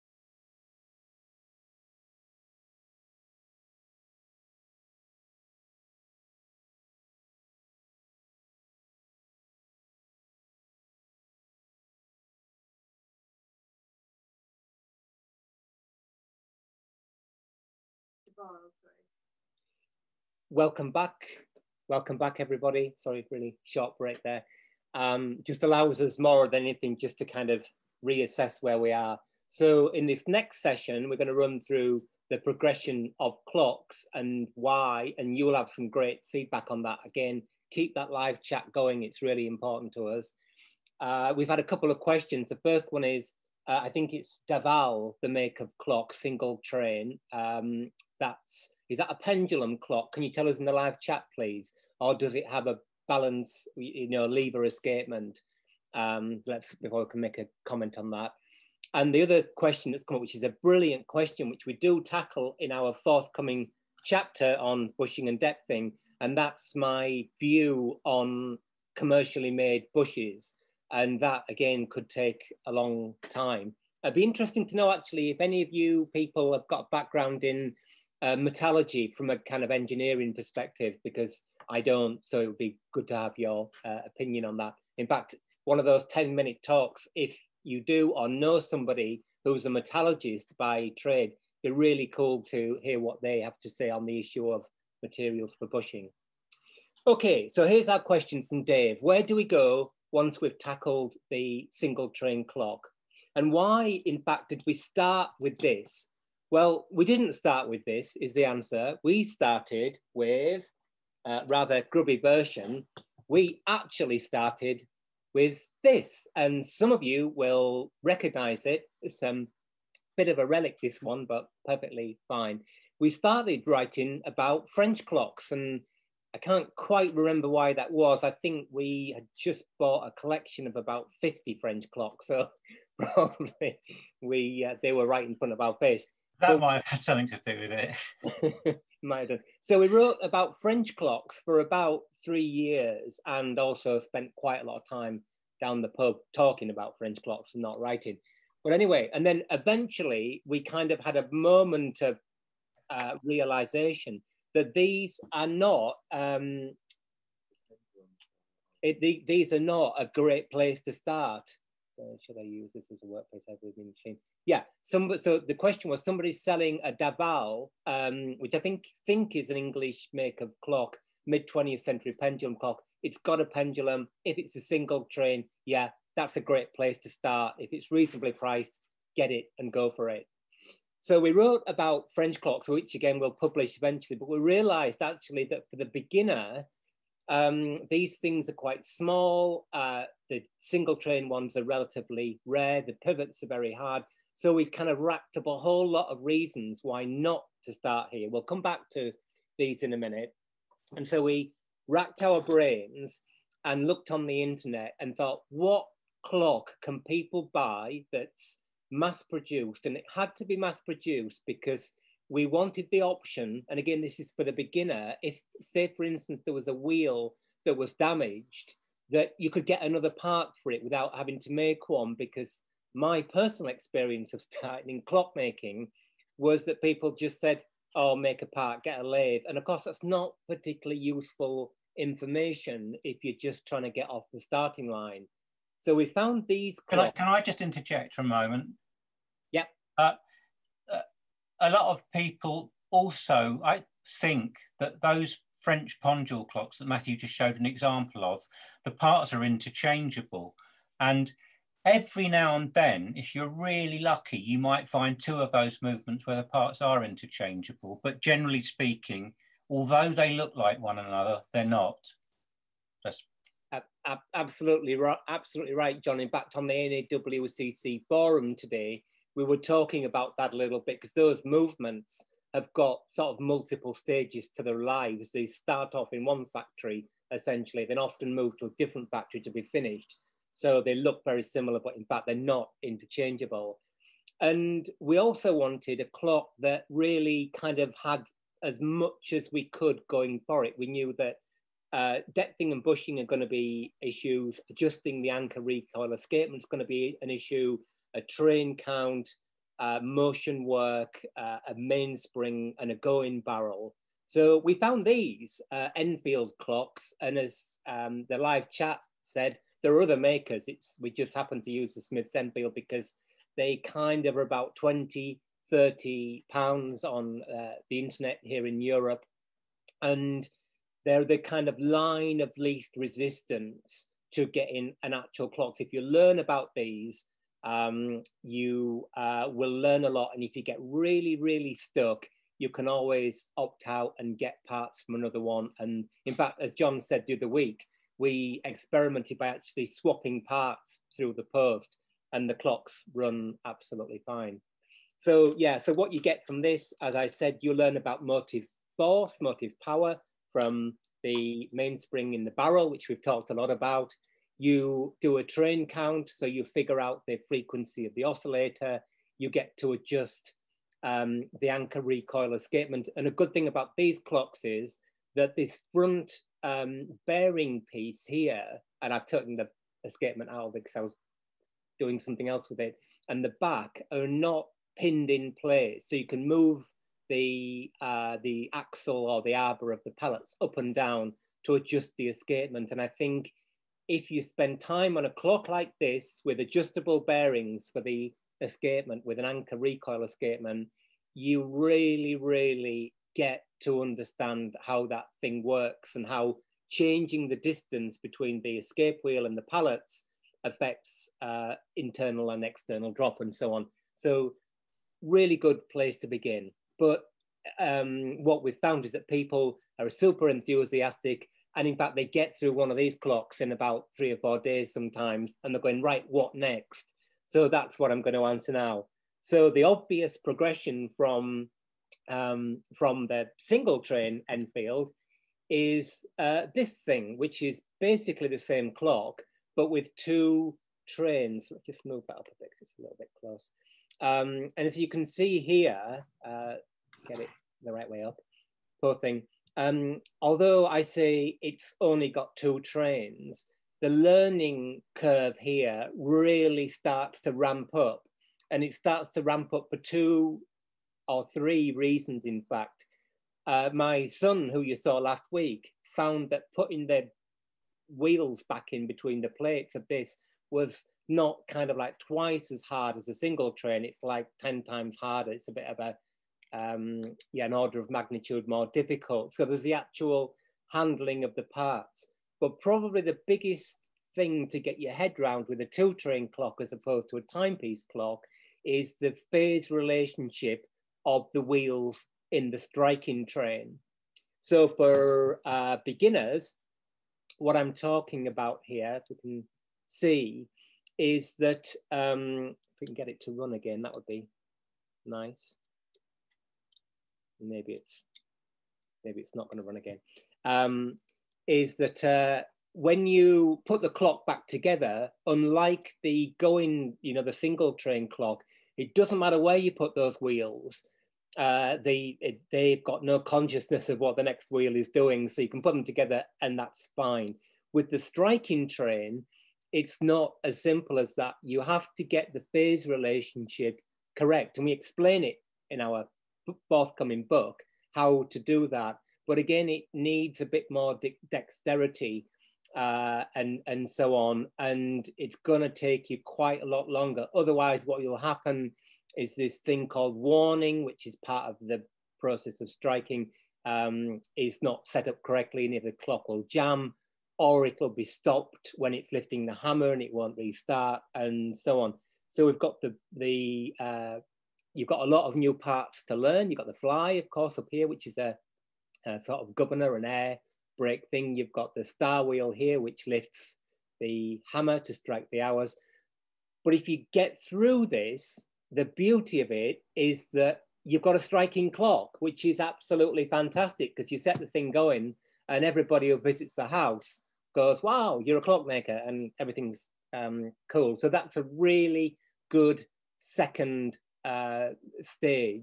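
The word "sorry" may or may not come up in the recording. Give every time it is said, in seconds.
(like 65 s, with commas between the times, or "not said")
18 s, 22 s.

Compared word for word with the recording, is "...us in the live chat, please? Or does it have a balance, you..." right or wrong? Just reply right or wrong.
right.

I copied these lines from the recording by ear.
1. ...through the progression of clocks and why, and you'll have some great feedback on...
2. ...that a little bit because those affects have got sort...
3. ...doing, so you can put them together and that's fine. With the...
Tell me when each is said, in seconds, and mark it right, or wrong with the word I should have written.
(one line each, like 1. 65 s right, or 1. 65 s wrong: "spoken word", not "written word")
1. 31 s right
2. 270 s wrong: "movements", not "affects"
3. 515 s right.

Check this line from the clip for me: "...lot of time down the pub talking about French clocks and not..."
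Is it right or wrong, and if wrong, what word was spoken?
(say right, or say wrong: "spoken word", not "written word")
right.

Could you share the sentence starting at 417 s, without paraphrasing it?
So that's what I'm going to answer now.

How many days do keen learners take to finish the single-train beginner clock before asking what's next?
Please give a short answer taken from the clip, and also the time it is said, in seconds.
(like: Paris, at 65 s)
3 or 4 days, at 414 s.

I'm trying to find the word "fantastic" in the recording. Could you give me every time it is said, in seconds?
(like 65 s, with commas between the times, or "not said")
573 s.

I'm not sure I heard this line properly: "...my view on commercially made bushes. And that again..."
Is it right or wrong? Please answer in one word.
right.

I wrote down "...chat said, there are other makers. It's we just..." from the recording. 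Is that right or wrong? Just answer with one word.
right.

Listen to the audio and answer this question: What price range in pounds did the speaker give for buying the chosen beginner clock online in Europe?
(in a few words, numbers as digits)
20 to 30 pounds.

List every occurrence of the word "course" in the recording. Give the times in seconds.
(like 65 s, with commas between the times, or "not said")
229 s, 557 s.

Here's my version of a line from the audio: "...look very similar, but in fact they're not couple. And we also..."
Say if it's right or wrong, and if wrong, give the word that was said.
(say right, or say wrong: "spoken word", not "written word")
wrong: "interchangeable", not "couple".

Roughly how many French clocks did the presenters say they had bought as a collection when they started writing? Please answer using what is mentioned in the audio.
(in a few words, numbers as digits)
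About 50.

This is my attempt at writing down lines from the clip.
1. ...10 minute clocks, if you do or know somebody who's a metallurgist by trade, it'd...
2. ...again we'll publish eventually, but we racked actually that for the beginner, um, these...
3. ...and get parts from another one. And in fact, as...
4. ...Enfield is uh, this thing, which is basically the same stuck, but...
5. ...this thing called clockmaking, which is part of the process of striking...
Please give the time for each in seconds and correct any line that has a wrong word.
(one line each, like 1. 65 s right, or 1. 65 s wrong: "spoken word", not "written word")
1. 86 s wrong: "talks", not "clocks"
2. 182 s wrong: "realized", not "racked"
3. 334 s right
4. 424 s wrong: "clock", not "stuck"
5. 539 s wrong: "warning", not "clockmaking".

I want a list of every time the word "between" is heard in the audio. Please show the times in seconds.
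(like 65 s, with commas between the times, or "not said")
398 s, 459 s.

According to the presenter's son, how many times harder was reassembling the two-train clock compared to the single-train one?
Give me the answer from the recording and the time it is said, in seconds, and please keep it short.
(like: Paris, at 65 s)
10 times, at 464 s.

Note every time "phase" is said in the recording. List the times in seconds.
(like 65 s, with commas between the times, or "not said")
479 s, 522 s.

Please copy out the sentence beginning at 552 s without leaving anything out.
So we've got the, the uh, you've got a lot of new parts to learn.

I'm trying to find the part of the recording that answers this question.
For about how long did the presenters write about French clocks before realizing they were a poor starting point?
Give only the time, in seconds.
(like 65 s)
141 s.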